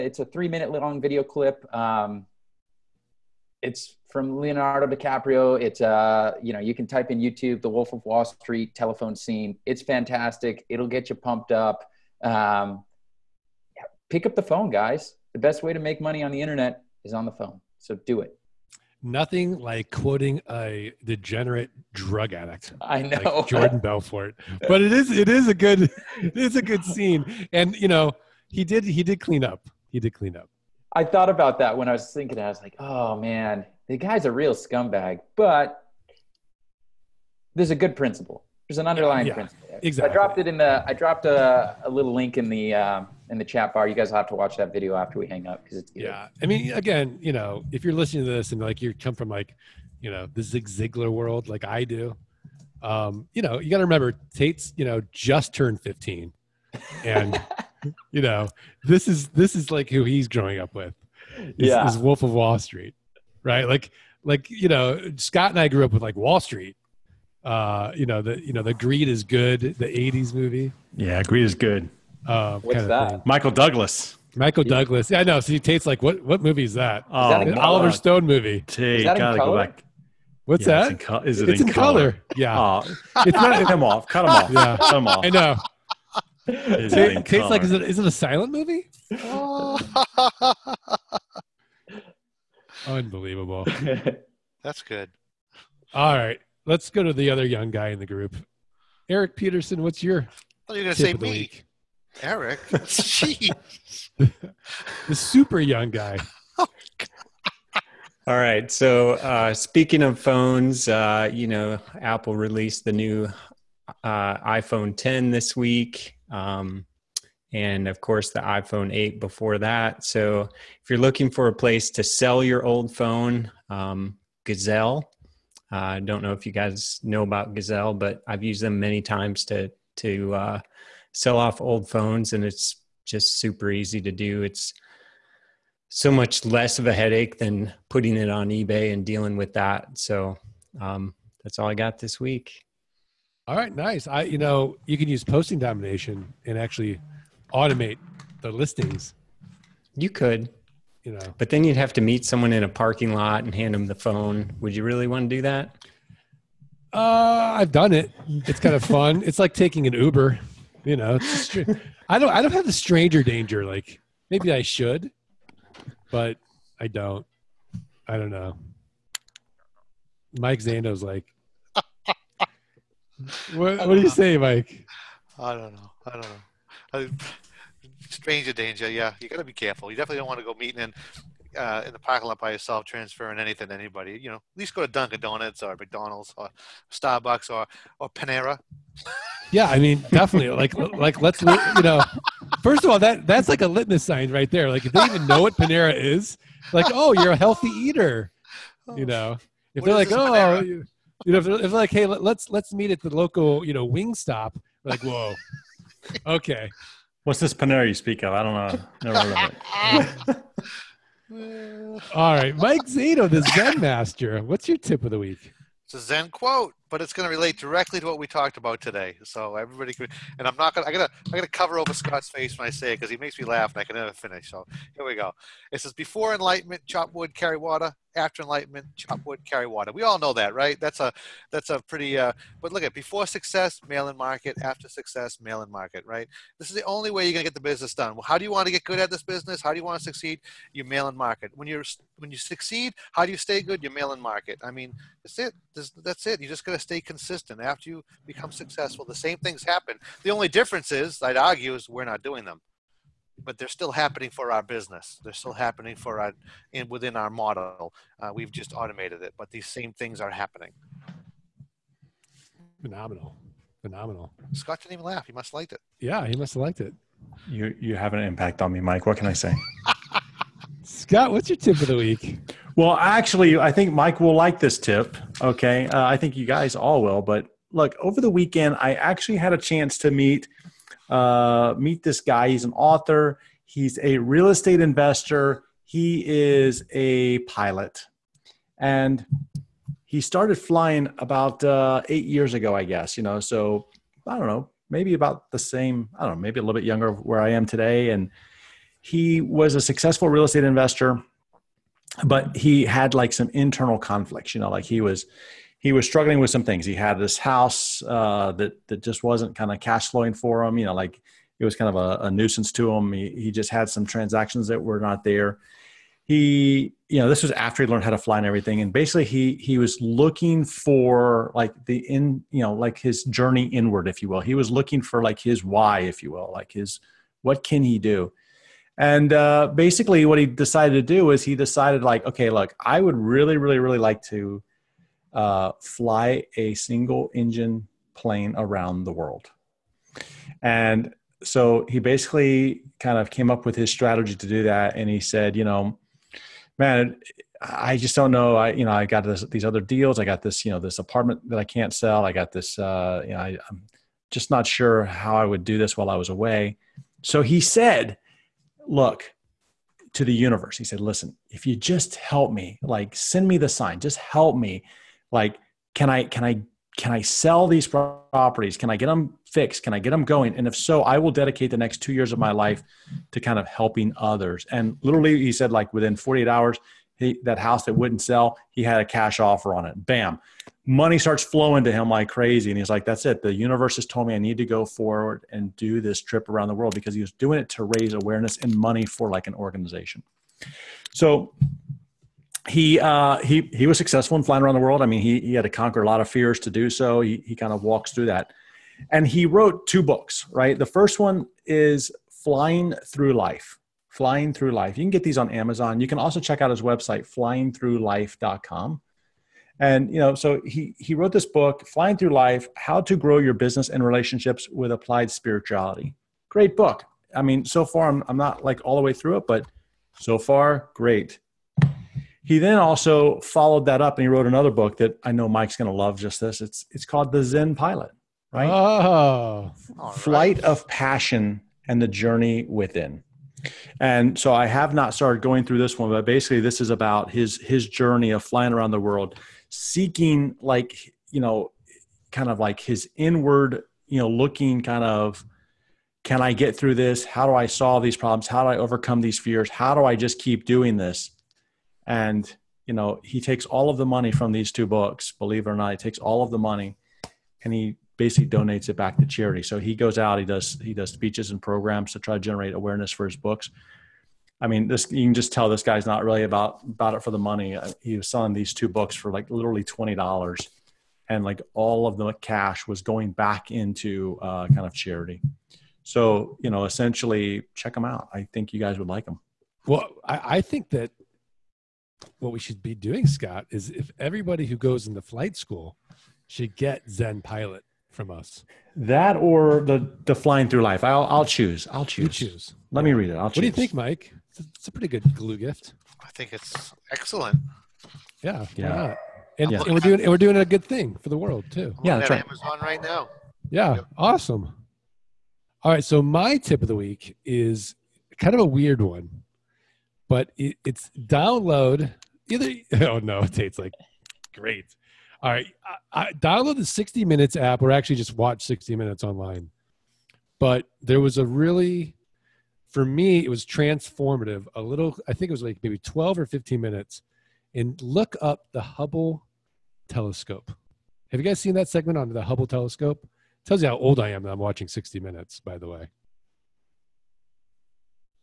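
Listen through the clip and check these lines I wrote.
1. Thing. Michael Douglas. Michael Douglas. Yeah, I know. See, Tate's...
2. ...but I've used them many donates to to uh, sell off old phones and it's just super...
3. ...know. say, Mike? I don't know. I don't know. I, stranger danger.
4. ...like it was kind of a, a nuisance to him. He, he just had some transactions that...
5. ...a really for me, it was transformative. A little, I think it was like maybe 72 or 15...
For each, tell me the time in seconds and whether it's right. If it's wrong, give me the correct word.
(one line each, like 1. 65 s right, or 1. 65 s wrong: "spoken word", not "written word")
1. 73 s right
2. 127 s wrong: "times", not "donates"
3. 174 s right
4. 310 s right
5. 521 s wrong: "12", not "72".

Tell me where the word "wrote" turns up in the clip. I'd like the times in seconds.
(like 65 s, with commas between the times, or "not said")
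399 s, 411 s, 424 s.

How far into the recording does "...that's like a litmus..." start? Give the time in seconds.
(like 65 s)
193 s.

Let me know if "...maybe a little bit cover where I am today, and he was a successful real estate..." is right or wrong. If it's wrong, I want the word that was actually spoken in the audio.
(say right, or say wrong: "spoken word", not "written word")
wrong: "younger", not "cover".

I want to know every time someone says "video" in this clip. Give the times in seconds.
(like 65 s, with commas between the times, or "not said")
1 s, 44 s.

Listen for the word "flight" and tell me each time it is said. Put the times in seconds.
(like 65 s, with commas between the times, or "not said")
430 s, 485 s.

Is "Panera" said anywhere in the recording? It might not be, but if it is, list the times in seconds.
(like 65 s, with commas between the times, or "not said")
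188 s, 195 s, 207 s.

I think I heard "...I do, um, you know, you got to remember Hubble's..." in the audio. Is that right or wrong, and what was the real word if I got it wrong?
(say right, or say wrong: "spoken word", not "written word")
wrong: "Tate", not "Hubble".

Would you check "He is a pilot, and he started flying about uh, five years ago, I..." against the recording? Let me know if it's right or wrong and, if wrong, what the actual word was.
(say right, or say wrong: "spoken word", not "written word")
wrong: "eight", not "five".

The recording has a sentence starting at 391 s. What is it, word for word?
So he uh, he he was successful in flying around the world.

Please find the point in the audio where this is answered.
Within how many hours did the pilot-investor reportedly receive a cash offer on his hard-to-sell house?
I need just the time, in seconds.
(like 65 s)
376 s.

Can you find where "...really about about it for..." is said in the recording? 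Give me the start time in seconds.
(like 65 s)
466 s.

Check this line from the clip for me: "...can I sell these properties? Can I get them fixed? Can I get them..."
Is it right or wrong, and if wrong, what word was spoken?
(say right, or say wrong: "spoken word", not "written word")
right.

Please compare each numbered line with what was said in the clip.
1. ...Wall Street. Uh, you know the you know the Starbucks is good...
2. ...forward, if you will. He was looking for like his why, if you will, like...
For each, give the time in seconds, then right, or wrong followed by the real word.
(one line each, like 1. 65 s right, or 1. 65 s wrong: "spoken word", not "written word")
1. 66 s wrong: "Greed", not "Starbucks"
2. 323 s wrong: "inward", not "forward".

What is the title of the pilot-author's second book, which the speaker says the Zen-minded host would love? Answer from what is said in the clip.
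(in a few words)
The Zen Pilot.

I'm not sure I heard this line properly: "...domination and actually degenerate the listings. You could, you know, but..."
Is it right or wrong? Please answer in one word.
wrong.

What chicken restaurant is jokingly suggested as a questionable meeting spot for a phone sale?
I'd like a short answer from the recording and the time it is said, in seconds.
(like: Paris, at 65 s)
Wingstop, at 203 s.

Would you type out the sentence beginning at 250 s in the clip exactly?
The only difference is, I'd argue, is we're not doing them, but they're still happening for our business.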